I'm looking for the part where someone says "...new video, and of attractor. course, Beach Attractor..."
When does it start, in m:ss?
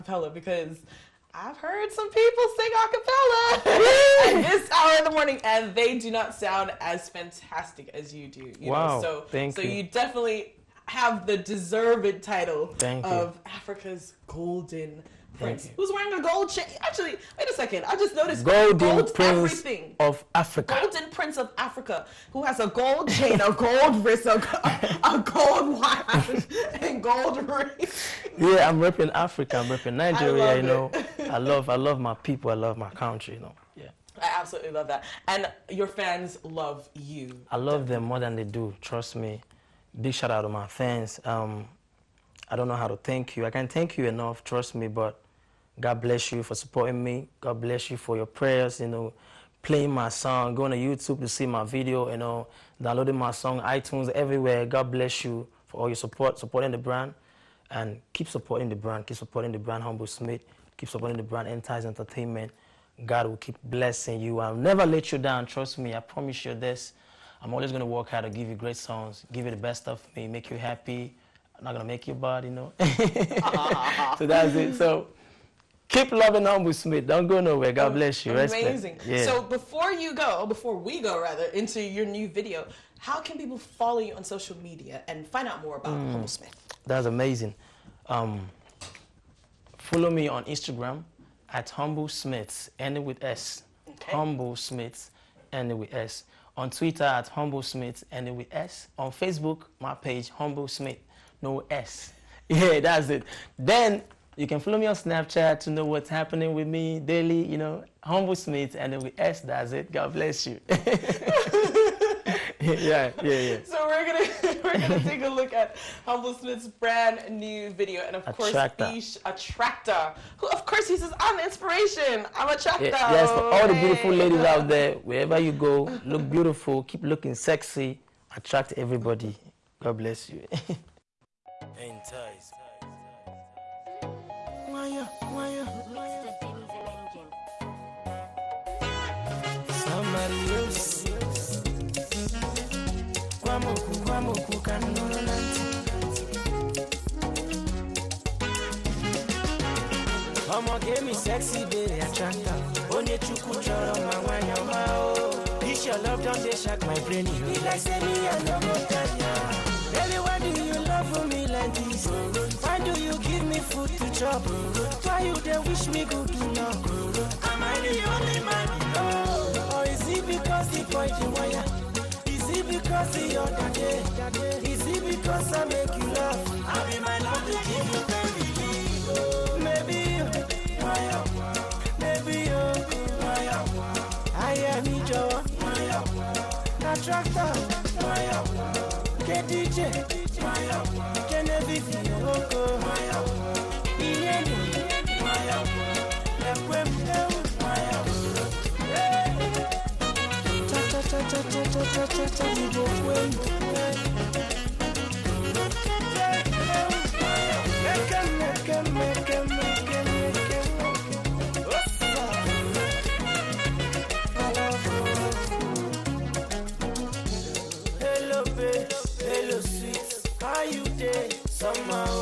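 1:57.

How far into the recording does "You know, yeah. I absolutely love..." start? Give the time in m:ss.
0:33.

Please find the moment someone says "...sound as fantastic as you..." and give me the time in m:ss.
0:06.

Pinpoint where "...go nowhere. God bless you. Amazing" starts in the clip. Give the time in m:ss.
1:17.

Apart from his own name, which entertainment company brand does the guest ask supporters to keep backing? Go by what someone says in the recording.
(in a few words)
Entice Entertainment.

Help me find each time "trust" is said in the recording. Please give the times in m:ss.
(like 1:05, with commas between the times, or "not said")
0:38, 0:44, 1:05.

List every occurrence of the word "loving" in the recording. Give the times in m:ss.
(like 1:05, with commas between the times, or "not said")
1:16.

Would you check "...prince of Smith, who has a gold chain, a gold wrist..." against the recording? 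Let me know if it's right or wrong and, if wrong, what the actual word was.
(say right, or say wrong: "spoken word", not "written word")
wrong: "Africa", not "Smith".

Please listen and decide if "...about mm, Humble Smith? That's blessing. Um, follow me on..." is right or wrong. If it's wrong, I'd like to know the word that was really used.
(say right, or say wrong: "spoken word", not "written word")
wrong: "amazing", not "blessing".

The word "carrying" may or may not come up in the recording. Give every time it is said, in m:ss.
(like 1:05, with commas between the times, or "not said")
not said.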